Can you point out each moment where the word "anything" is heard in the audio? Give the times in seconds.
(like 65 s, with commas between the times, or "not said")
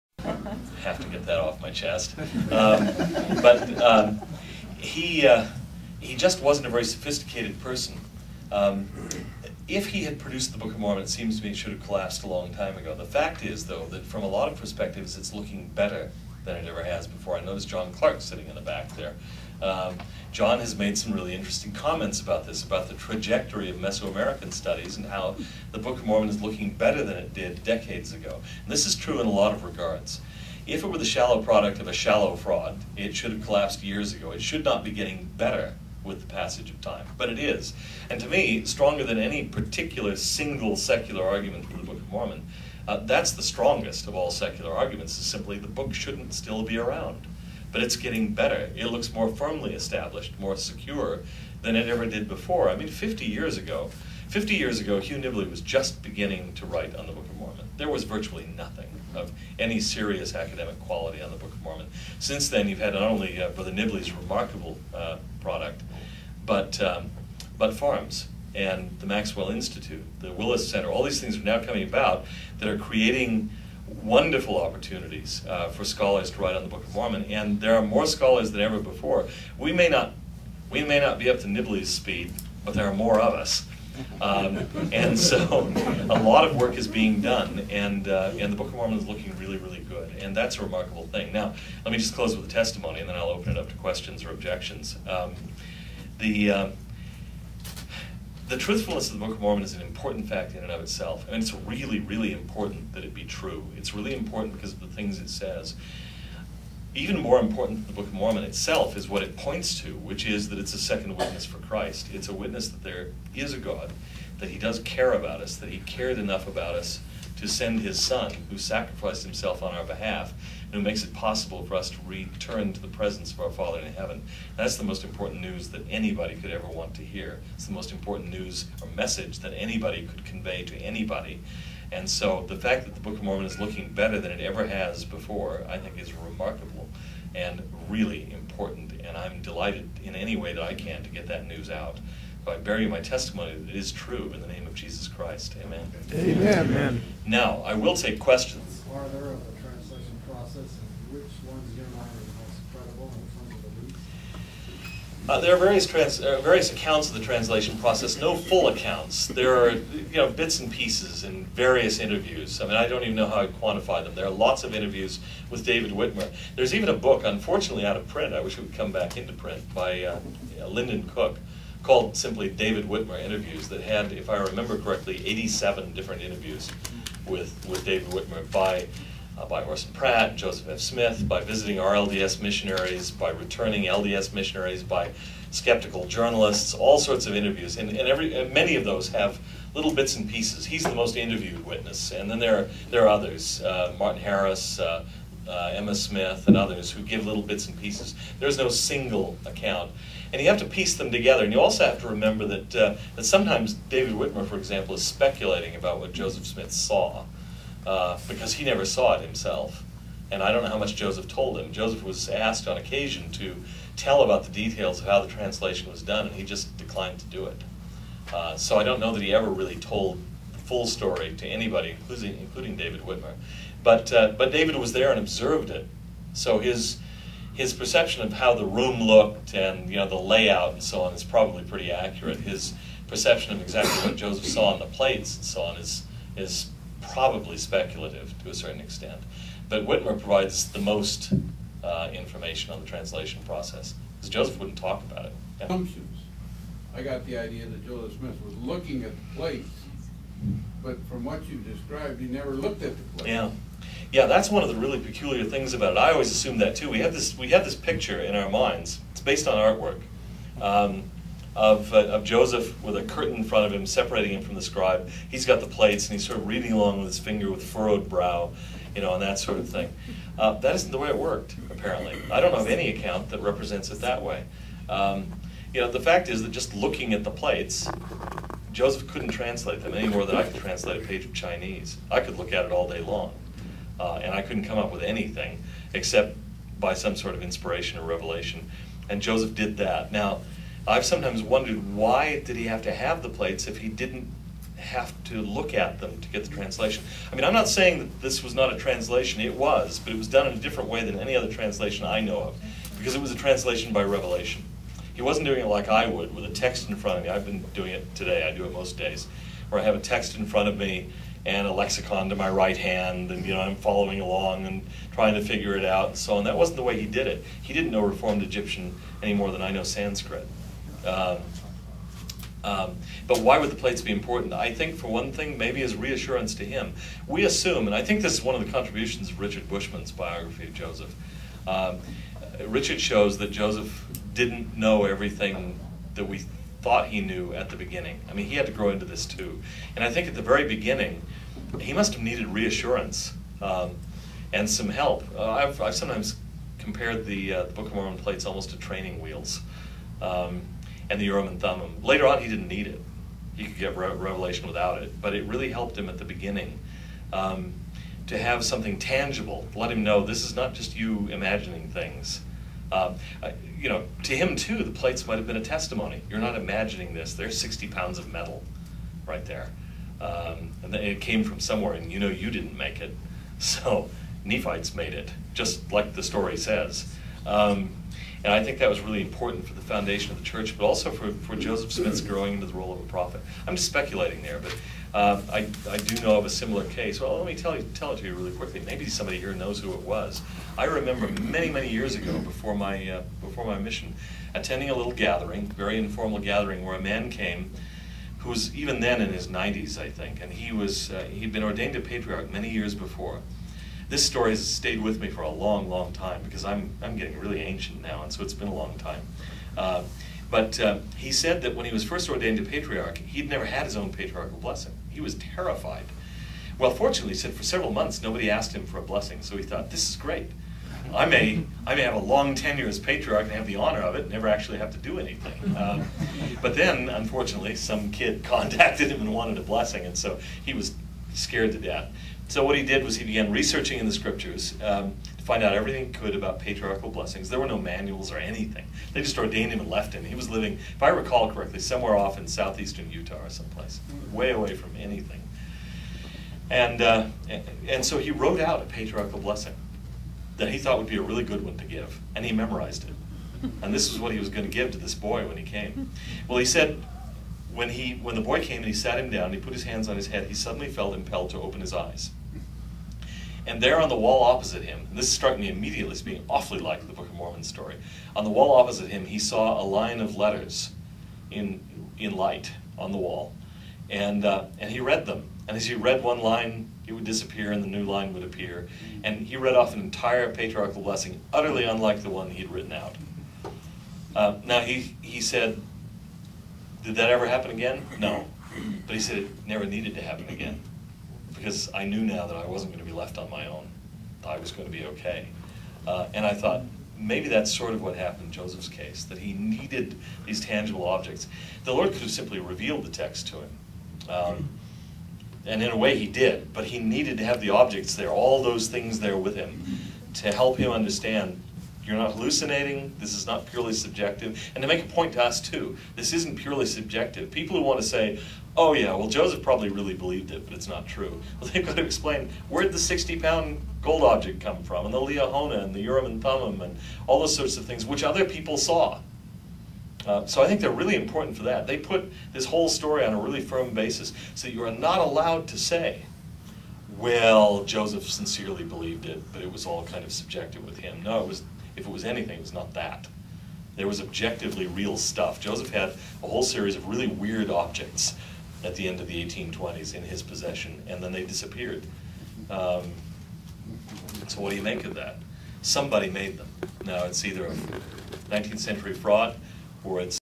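285 s, 425 s, 438 s, 444 s, 542 s.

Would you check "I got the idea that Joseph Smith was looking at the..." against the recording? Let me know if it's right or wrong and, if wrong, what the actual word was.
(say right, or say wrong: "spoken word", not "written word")
right.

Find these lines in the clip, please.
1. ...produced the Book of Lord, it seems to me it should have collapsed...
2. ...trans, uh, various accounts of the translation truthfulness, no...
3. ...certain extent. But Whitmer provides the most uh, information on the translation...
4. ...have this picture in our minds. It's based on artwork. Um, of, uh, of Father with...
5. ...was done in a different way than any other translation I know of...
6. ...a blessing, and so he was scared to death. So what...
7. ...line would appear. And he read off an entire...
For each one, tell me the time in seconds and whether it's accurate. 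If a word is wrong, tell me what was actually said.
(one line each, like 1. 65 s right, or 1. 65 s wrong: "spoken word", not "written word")
1. 10 s wrong: "Mormon", not "Lord"
2. 155 s wrong: "process", not "truthfulness"
3. 238 s right
4. 257 s wrong: "Joseph", not "Father"
5. 300 s right
6. 429 s right
7. 478 s right.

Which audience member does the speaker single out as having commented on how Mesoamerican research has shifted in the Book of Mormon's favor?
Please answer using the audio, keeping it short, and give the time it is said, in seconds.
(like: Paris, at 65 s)
John Clark, at 17 s.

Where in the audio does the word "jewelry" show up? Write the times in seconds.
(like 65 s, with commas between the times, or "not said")
not said.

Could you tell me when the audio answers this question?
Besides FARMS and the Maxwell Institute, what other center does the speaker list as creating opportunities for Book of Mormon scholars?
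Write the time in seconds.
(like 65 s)
70 s.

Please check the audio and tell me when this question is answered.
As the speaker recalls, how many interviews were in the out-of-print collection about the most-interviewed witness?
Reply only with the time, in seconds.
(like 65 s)
175 s.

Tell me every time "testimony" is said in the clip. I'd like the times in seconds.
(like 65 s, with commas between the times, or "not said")
92 s, 143 s, 365 s.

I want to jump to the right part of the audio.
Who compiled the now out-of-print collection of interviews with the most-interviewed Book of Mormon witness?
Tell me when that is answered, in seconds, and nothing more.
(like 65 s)
170 s.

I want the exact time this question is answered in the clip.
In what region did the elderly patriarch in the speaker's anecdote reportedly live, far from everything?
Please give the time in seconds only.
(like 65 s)
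442 s.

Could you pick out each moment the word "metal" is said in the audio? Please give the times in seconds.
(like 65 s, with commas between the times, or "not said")
368 s.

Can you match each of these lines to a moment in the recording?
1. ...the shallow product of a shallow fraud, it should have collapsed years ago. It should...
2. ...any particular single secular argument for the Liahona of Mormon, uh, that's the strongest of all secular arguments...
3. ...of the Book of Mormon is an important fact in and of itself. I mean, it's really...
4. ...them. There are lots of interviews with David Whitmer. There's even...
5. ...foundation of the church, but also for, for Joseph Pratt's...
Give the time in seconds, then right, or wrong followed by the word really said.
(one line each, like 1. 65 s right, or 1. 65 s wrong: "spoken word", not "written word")
1. 30 s right
2. 39 s wrong: "Book", not "Liahona"
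3. 99 s right
4. 164 s right
5. 379 s wrong: "Smith", not "Pratt".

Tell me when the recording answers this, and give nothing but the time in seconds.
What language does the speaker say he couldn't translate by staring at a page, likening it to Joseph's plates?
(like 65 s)
281 s.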